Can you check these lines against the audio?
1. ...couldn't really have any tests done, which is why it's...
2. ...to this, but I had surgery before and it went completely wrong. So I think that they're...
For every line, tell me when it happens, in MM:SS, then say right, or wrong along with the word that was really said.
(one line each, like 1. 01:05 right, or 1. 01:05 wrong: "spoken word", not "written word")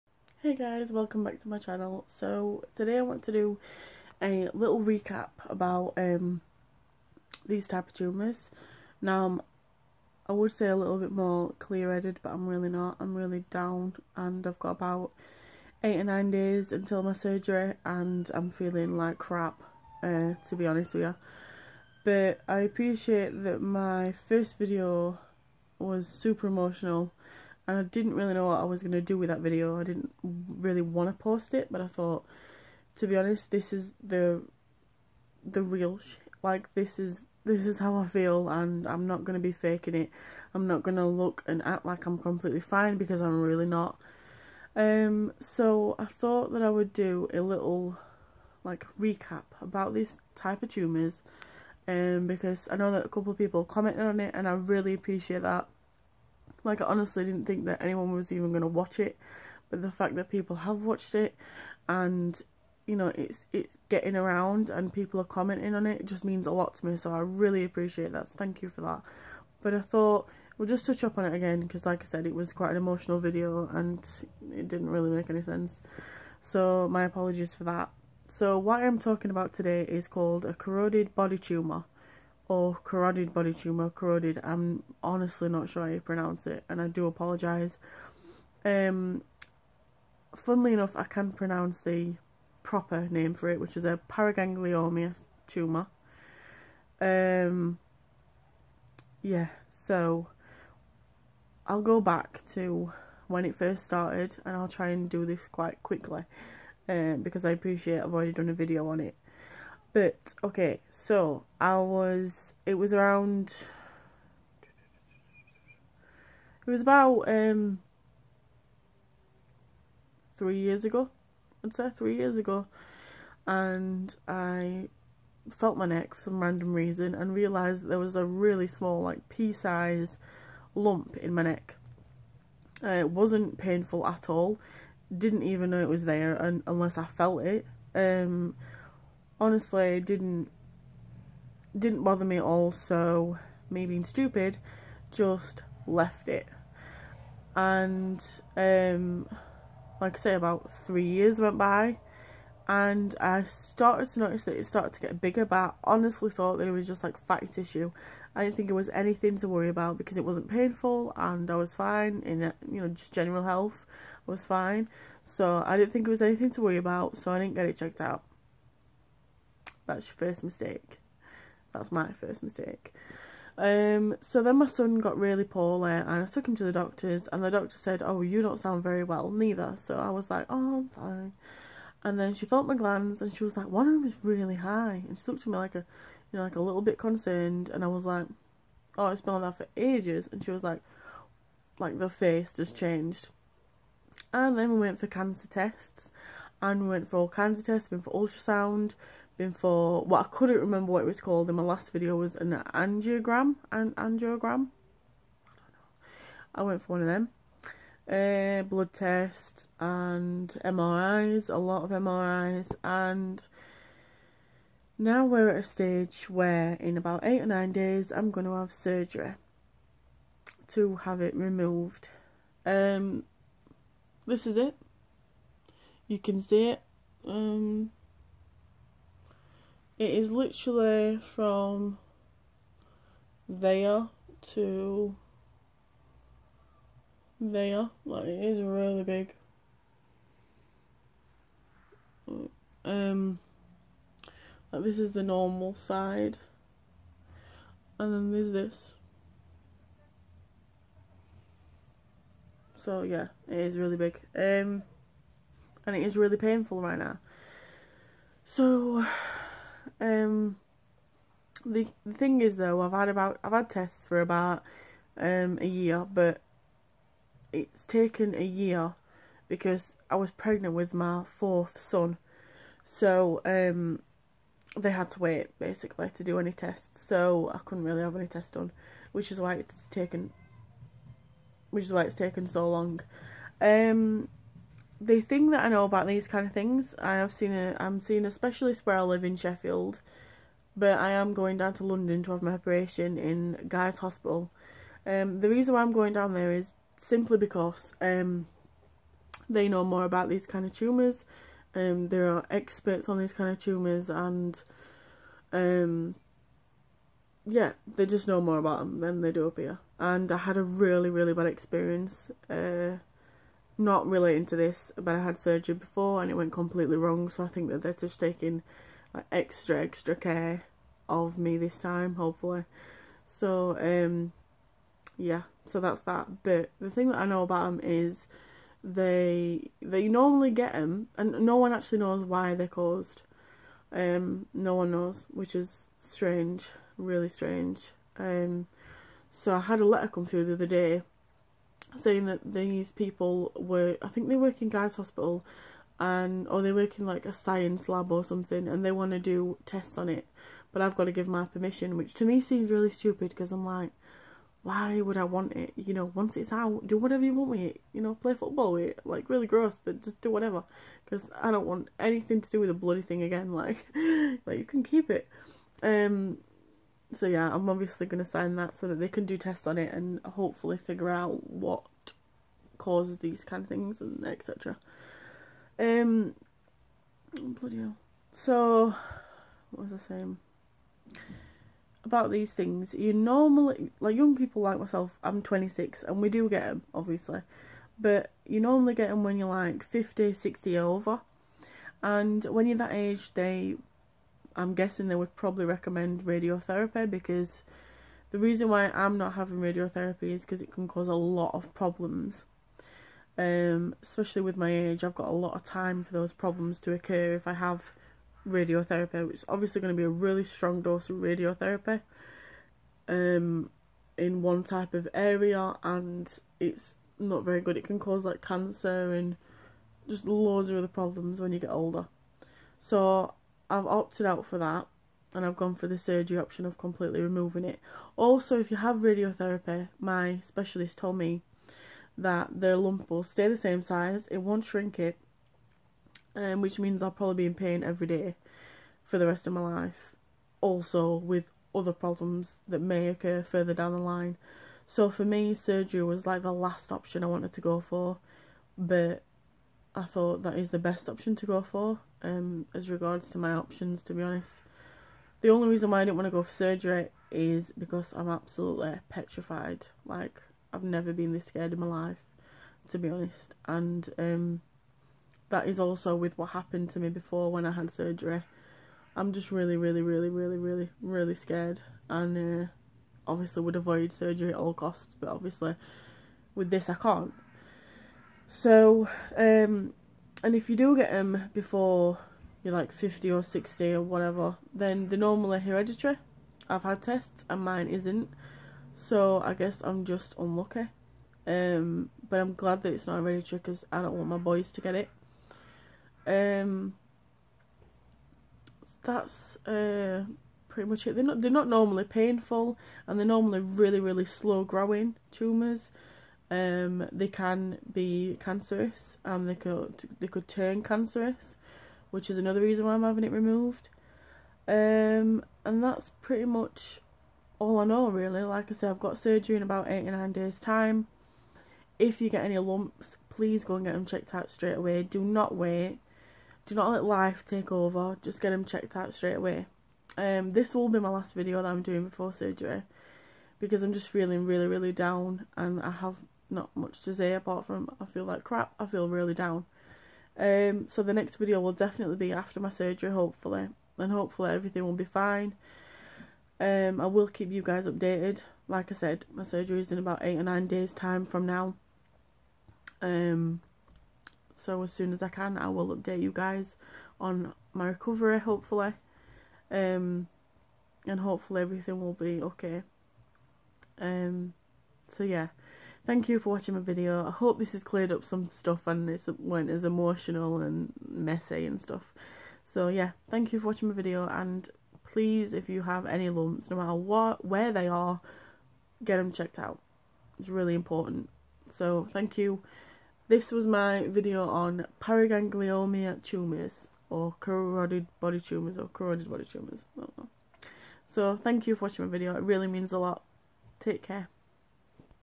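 1. 04:37 right
2. 05:14 right.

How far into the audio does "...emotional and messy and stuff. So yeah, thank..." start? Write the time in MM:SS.
09:29.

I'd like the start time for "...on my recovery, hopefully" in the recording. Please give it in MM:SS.
09:17.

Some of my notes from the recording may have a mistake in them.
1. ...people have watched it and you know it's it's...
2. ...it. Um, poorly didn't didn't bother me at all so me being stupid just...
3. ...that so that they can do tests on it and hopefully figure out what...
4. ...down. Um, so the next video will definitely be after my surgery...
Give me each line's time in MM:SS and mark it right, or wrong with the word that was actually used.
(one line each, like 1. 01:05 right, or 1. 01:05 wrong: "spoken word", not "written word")
1. 01:00 right
2. 02:17 wrong: "honestly", not "poorly"
3. 06:08 right
4. 08:59 right.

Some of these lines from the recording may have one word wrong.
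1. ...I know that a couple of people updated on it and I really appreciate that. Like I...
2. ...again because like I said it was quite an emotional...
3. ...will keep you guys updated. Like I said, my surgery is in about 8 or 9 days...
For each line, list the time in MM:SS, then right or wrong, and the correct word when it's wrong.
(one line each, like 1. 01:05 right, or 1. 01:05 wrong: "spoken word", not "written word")
1. 00:52 wrong: "commented", not "updated"
2. 01:11 right
3. 09:07 right.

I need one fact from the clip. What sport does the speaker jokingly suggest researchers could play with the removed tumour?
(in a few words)
Football.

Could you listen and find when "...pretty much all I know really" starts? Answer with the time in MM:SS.
08:36.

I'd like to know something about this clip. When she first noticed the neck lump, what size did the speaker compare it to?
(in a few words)
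Pea size.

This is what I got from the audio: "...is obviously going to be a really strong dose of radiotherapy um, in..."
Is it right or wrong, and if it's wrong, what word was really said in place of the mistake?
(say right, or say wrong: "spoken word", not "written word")
right.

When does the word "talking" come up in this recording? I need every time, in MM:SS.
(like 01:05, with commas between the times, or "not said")
01:18.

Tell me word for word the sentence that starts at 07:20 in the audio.
Also, with other problems that may occur further down the line.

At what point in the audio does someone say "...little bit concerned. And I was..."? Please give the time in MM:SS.
03:06.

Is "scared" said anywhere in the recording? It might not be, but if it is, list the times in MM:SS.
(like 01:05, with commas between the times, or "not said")
07:41, 07:51.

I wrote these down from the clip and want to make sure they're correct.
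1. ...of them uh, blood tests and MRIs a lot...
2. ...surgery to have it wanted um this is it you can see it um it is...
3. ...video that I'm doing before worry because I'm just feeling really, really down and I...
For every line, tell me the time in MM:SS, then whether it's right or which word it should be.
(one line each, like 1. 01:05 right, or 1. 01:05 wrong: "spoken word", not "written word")
1. 03:27 right
2. 03:38 wrong: "removed", not "wanted"
3. 08:51 wrong: "surgery", not "worry".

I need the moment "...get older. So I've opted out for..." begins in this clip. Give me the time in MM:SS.
07:01.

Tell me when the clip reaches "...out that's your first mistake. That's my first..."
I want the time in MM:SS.
02:48.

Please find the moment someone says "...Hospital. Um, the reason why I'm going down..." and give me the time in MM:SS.
04:53.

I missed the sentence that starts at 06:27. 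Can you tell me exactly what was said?
But you normally get them when you're like 50, 60 over.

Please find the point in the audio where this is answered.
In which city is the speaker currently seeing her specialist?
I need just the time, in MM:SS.
04:49.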